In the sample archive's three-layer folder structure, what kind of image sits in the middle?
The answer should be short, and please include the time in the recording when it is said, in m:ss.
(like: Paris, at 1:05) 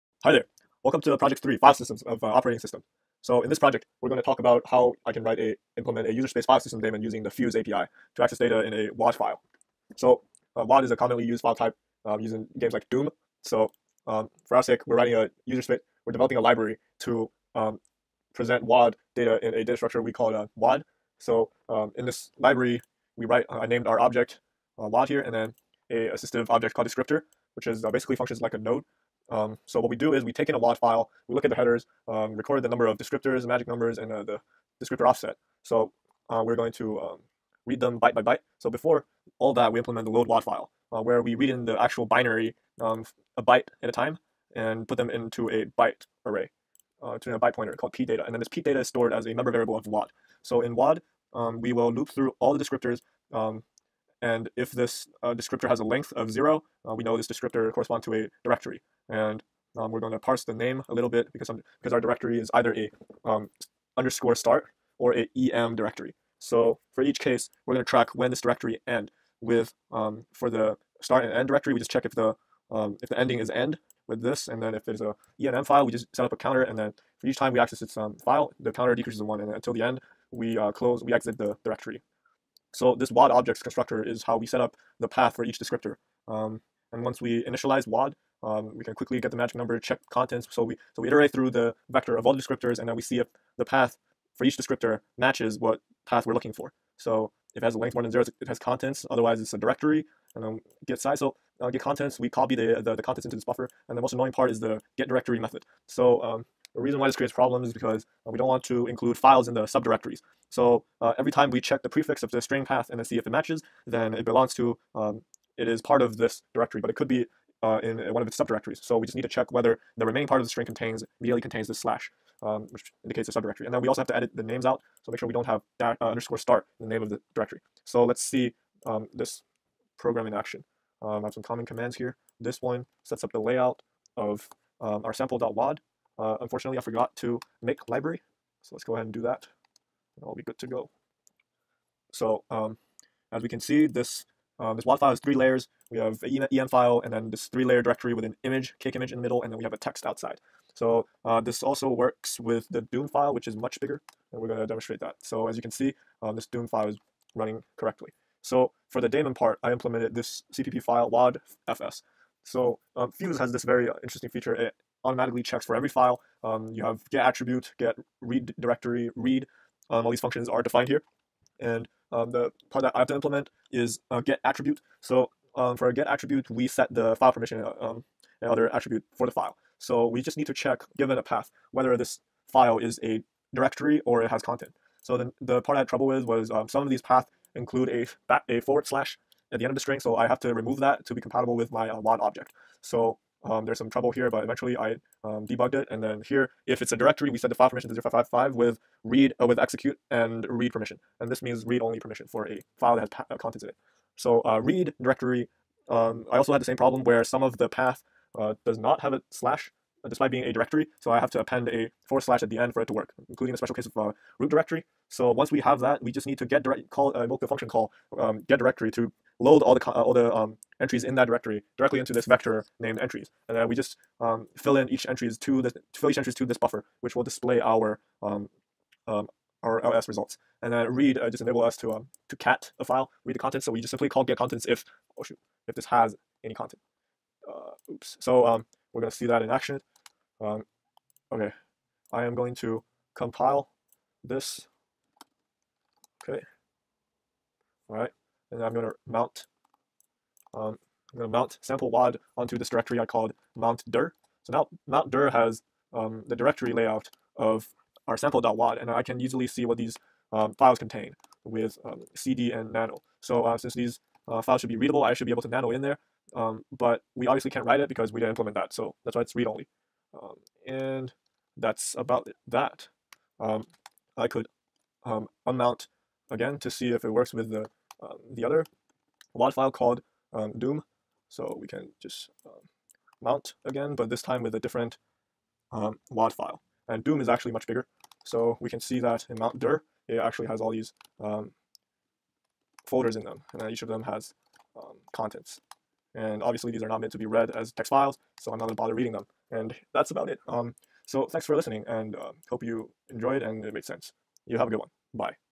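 cake image, at 2:28.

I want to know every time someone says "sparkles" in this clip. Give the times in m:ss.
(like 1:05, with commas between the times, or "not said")
not said.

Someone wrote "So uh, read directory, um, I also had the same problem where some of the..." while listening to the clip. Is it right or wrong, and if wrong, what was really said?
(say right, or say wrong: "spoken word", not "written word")
right.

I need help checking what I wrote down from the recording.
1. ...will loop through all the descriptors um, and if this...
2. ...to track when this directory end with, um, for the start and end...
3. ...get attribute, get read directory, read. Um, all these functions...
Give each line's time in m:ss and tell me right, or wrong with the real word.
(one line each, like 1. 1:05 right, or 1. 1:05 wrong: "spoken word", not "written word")
1. 0:51 right
2. 1:07 right
3. 2:47 right.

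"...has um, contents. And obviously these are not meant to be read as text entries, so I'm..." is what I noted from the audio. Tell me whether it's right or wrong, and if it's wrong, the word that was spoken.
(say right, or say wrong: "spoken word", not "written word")
wrong: "files", not "entries".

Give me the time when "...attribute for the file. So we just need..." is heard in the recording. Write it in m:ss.
2:58.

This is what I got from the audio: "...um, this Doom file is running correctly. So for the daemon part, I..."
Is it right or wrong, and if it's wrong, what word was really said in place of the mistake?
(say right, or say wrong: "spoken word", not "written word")
right.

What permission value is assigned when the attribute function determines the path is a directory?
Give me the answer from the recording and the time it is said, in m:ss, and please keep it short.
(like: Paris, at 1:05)
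0555, at 3:18.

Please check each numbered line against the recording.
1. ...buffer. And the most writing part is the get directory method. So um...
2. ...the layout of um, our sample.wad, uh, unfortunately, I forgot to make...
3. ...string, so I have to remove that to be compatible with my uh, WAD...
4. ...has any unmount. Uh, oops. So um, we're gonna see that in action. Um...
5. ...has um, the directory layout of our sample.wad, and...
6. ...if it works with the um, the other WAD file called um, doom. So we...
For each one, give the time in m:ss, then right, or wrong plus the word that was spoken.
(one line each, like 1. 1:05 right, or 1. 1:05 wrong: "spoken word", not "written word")
1. 1:43 wrong: "annoying", not "writing"
2. 2:13 right
3. 3:09 right
4. 3:55 wrong: "content", not "unmount"
5. 4:15 right
6. 4:36 right.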